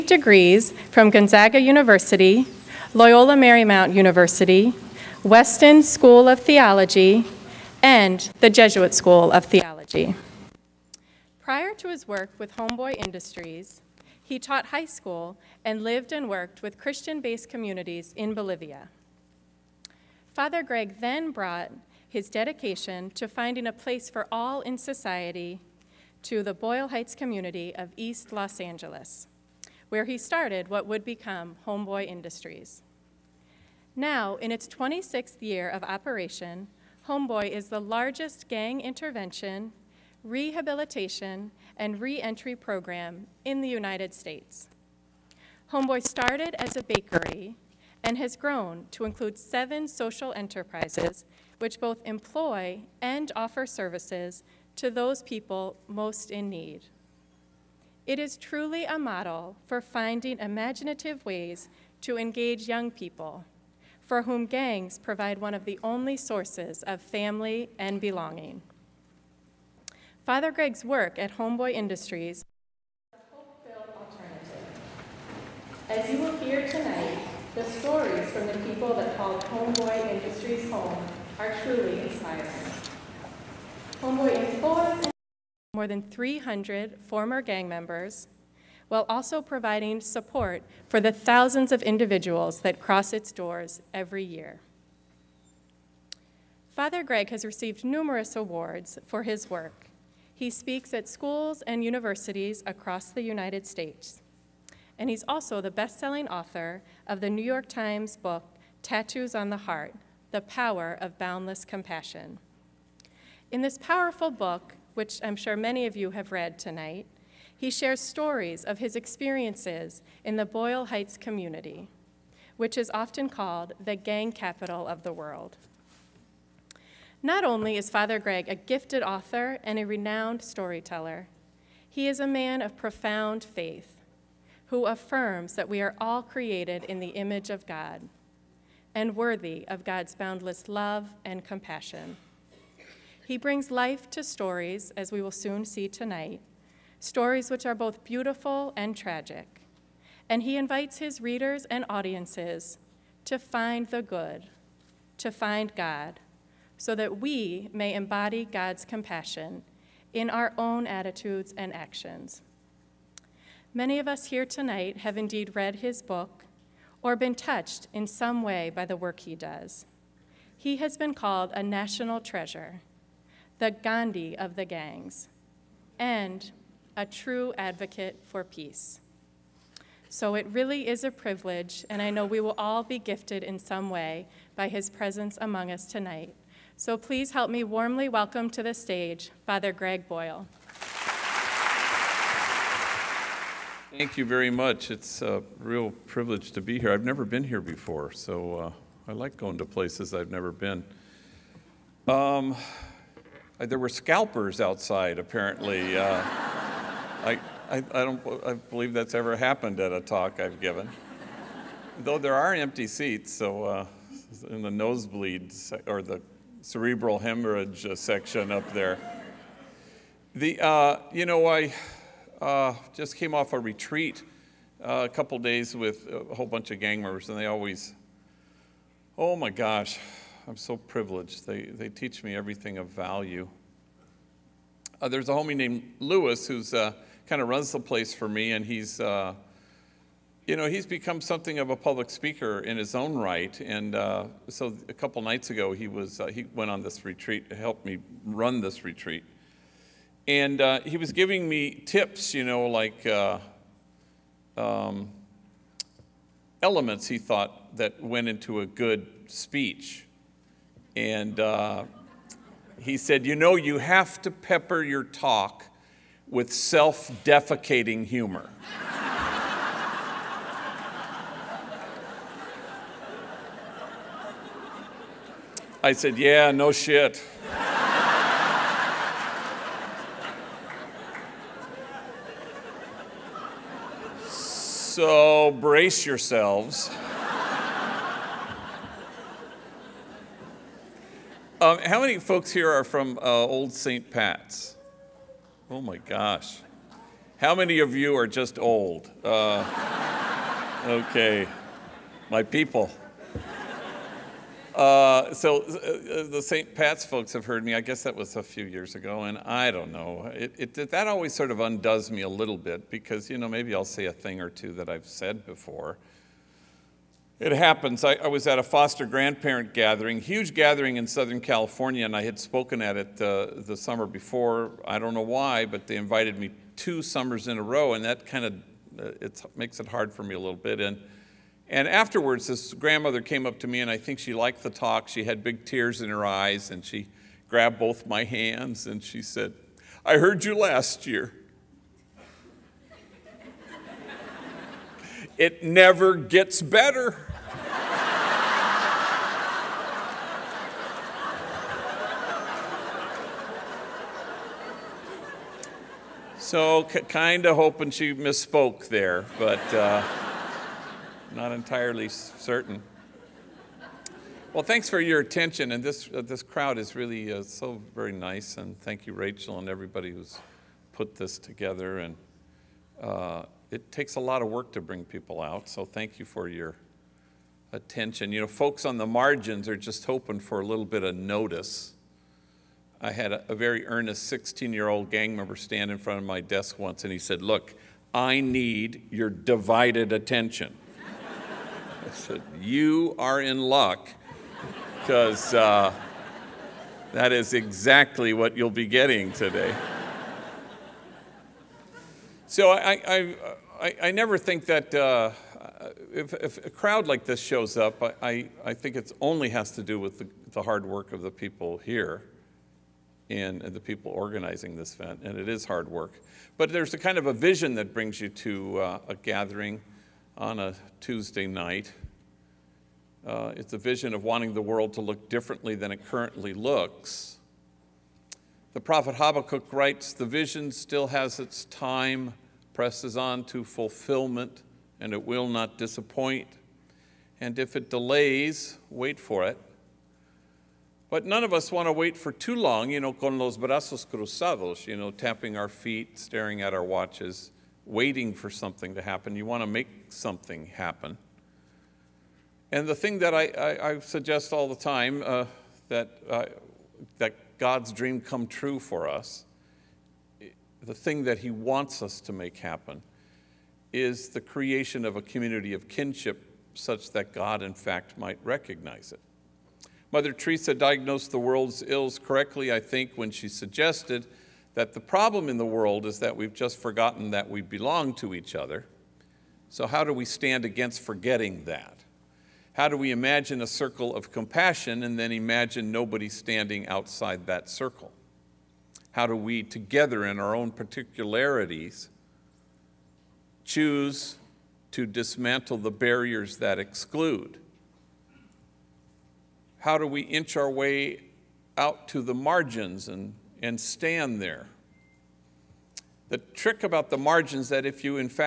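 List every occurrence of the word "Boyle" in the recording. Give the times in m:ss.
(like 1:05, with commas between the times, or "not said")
0:26, 2:00, 3:10.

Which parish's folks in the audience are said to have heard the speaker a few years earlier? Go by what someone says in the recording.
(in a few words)
Old St. Pat's.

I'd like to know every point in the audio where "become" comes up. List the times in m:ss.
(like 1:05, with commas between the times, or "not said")
0:31, 4:00.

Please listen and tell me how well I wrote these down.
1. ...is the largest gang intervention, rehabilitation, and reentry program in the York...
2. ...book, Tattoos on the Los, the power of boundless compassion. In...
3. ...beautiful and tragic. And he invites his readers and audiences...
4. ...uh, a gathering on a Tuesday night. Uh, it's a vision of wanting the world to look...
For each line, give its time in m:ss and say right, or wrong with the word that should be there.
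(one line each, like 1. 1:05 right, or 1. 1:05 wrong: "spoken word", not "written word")
1. 0:37 wrong: "United", not "York"
2. 1:48 wrong: "Heart", not "Los"
3. 2:28 right
4. 6:58 right.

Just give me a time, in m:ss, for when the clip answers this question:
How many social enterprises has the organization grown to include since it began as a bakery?
0:49.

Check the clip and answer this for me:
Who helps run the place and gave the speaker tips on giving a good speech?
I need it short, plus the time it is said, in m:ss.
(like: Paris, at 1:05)
Lewis, at 3:55.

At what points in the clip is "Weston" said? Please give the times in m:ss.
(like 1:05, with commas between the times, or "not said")
0:05.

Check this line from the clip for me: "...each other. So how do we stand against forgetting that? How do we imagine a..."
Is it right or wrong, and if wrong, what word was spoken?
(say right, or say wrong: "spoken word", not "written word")
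right.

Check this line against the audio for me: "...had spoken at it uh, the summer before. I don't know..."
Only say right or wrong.
right.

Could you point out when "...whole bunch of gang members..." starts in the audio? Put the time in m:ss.
3:46.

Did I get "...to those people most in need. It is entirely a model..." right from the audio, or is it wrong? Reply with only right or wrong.
wrong.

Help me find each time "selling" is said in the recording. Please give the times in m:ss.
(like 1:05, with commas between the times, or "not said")
1:45.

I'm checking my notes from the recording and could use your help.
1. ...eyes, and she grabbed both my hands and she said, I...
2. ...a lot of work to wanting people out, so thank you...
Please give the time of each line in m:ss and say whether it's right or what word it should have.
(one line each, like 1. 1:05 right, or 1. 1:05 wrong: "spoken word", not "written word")
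1. 5:36 right
2. 6:14 wrong: "bring", not "wanting".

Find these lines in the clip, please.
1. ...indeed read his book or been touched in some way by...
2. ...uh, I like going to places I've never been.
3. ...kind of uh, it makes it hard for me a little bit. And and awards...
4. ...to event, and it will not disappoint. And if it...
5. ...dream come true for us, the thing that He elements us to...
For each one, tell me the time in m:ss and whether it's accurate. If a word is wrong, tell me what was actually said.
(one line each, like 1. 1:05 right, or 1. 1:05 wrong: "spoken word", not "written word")
1. 2:45 right
2. 3:18 right
3. 5:28 wrong: "afterwards", not "awards"
4. 7:13 wrong: "fulfillment", not "event"
5. 7:37 wrong: "wants", not "elements".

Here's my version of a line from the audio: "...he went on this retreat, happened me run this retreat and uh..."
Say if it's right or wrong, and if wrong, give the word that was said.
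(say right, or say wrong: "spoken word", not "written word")
wrong: "helped", not "happened".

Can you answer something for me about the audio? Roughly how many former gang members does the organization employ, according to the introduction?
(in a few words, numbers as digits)
More than 300.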